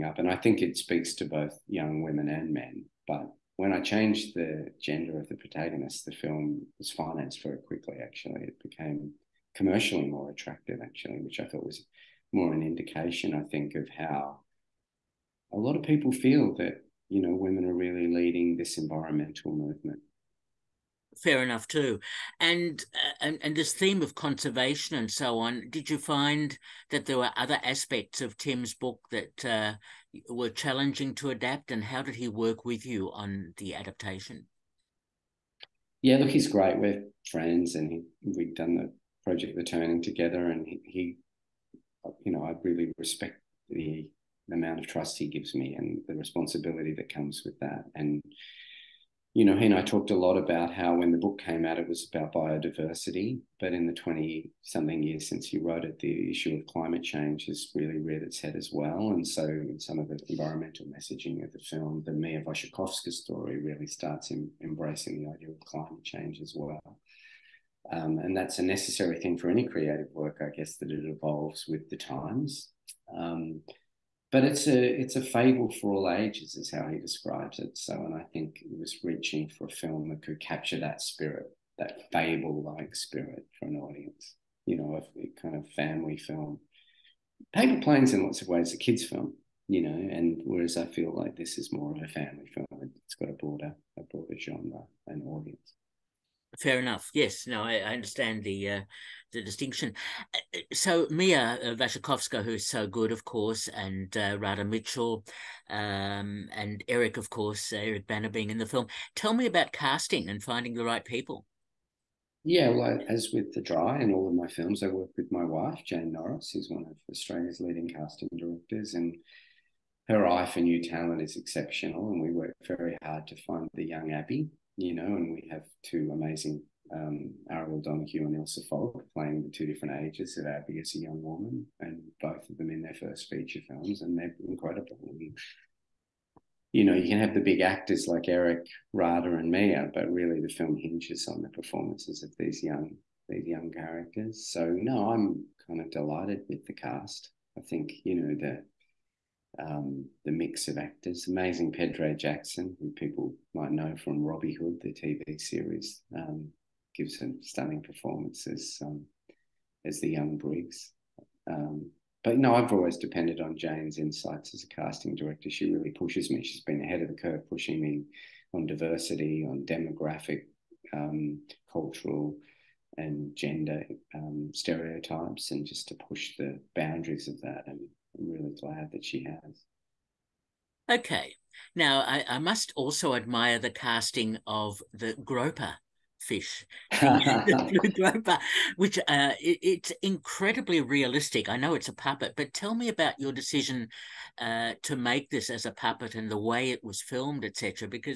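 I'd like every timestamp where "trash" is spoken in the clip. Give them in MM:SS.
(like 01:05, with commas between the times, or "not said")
not said.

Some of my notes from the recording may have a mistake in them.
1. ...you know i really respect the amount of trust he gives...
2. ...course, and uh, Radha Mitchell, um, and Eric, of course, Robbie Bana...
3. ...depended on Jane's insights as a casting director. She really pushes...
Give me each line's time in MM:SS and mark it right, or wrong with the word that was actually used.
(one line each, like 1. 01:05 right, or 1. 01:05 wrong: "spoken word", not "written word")
1. 00:42 right
2. 01:43 wrong: "Eric", not "Robbie"
3. 02:42 right.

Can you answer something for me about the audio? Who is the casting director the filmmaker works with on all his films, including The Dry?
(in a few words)
Jane Norris.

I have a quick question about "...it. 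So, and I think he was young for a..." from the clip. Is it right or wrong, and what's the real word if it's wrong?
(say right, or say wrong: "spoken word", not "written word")
wrong: "reaching", not "young".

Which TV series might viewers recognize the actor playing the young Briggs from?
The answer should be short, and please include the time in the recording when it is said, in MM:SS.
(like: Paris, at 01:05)
Robbie Hood, at 02:34.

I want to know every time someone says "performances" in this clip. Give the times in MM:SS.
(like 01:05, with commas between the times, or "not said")
02:21, 02:37.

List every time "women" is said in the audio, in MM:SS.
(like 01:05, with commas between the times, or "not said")
00:02, 00:17.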